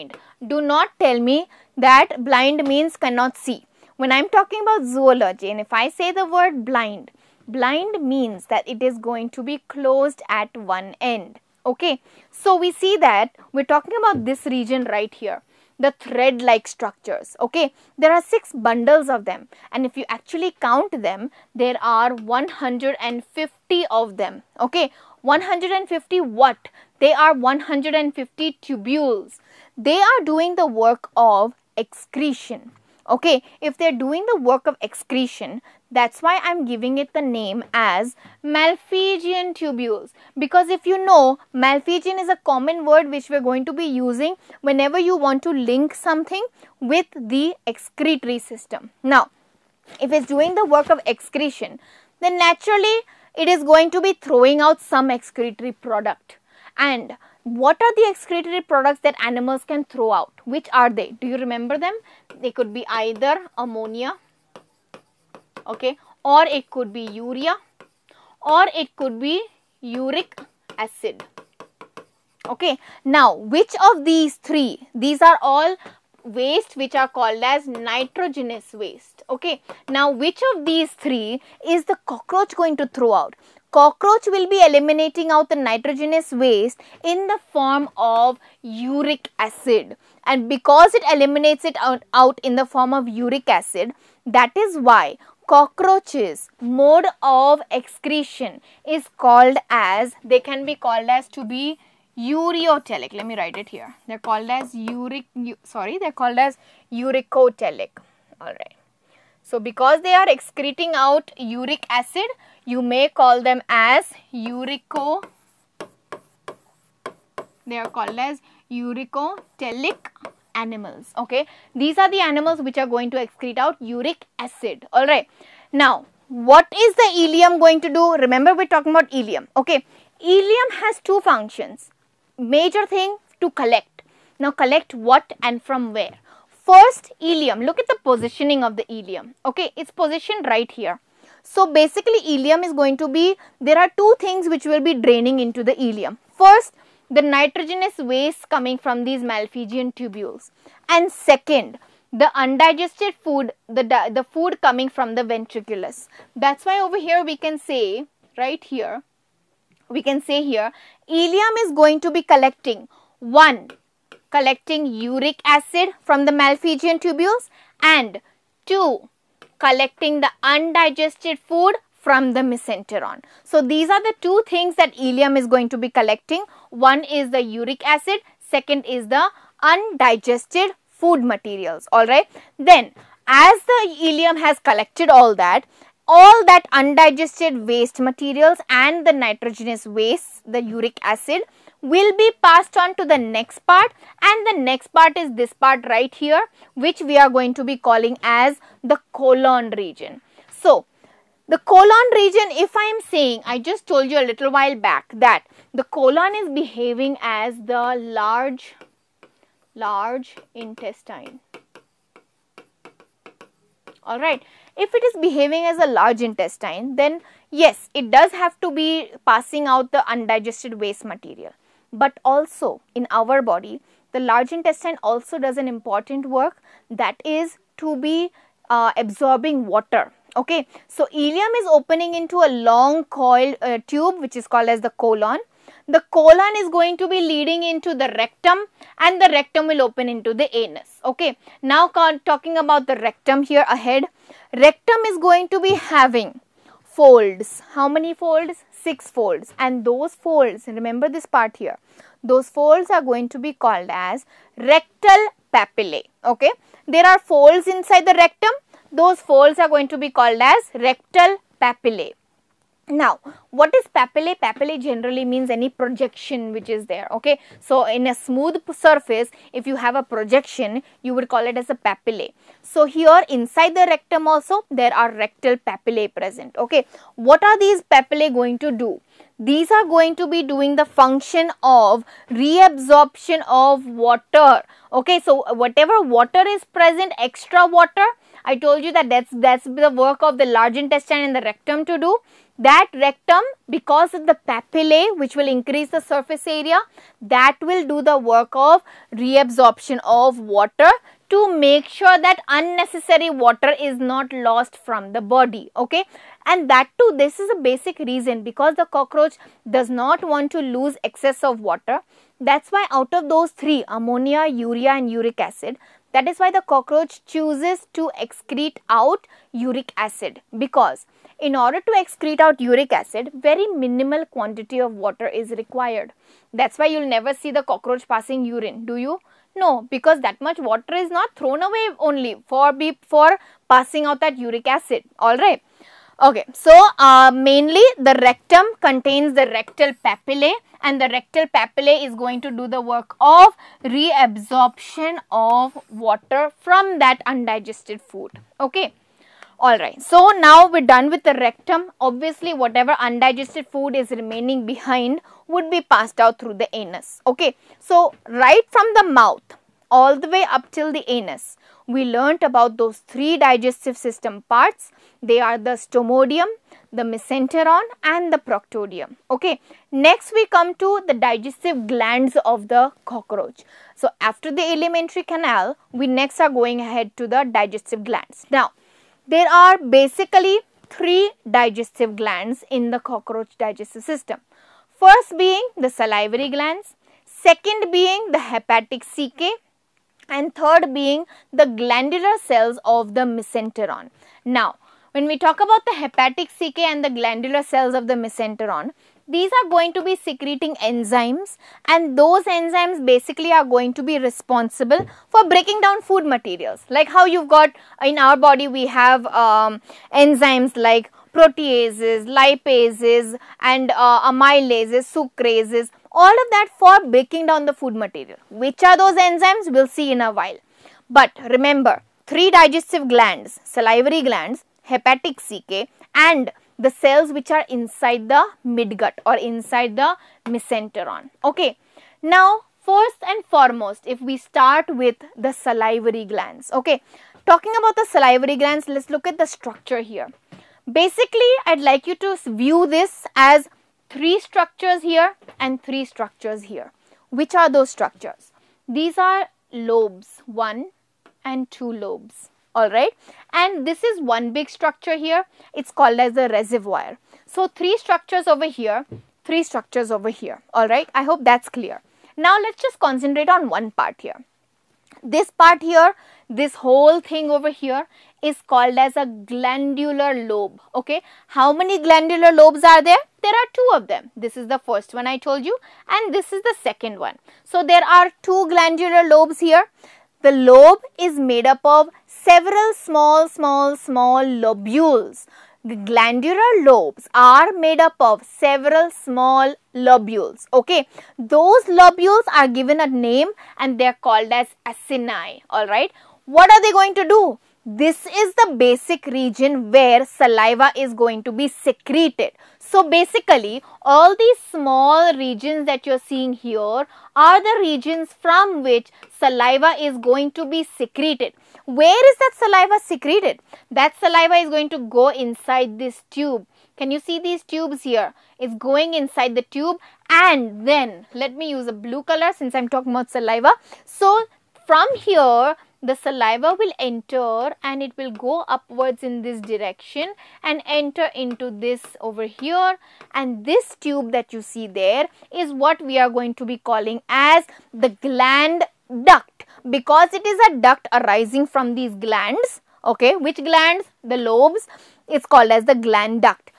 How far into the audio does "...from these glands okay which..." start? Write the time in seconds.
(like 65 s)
541 s.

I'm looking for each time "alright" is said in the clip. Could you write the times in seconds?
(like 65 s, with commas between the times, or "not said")
181 s, 214 s, 349 s.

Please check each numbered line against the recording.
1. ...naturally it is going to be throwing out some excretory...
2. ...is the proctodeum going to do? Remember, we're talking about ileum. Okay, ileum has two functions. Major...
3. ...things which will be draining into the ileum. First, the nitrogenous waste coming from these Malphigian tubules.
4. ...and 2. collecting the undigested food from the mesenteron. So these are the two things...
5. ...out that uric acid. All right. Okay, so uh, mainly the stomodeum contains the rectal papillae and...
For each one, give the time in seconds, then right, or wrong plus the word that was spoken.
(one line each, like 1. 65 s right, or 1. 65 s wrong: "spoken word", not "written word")
1. 52 s right
2. 126 s wrong: "ileum", not "proctodeum"
3. 144 s right
4. 167 s right
5. 334 s wrong: "rectum", not "stomodeum".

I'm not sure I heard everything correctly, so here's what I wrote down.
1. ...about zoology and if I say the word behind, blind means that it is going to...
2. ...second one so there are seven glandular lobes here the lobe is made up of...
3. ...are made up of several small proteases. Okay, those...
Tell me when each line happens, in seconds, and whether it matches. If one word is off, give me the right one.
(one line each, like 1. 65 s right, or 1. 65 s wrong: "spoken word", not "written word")
1. 4 s wrong: "blind", not "behind"
2. 476 s wrong: "two", not "seven"
3. 487 s wrong: "lobules", not "proteases".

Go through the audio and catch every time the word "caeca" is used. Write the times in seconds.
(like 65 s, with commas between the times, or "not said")
389 s, 396 s, 425 s.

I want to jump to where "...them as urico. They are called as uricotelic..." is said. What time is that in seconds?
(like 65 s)
113 s.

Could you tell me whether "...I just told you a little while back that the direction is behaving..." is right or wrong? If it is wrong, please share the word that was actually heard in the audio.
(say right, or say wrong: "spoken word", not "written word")
wrong: "colon", not "direction".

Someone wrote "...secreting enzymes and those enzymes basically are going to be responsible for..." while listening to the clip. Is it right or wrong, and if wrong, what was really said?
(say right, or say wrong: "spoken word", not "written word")
right.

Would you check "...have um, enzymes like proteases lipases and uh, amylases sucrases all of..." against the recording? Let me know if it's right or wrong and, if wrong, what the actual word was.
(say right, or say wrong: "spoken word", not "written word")
right.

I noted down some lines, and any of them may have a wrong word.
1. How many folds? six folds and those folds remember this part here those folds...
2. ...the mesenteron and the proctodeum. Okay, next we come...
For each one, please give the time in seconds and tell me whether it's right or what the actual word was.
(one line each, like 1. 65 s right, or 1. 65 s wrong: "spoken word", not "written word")
1. 247 s right
2. 366 s right.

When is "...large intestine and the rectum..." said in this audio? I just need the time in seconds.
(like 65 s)
290 s.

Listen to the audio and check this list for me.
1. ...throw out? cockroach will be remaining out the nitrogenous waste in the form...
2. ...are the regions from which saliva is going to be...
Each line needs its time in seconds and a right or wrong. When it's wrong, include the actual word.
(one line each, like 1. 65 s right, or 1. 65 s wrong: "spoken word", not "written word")
1. 82 s wrong: "eliminating", not "remaining"
2. 507 s right.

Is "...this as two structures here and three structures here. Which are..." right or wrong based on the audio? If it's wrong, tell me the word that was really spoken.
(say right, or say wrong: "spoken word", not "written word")
wrong: "three", not "two".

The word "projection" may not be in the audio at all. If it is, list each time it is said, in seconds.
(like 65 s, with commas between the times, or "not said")
265 s, 270 s.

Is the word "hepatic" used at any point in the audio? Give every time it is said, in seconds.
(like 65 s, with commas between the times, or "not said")
388 s, 395 s, 424 s.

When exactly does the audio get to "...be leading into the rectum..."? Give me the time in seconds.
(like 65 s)
237 s.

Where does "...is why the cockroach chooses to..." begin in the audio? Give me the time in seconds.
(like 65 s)
316 s.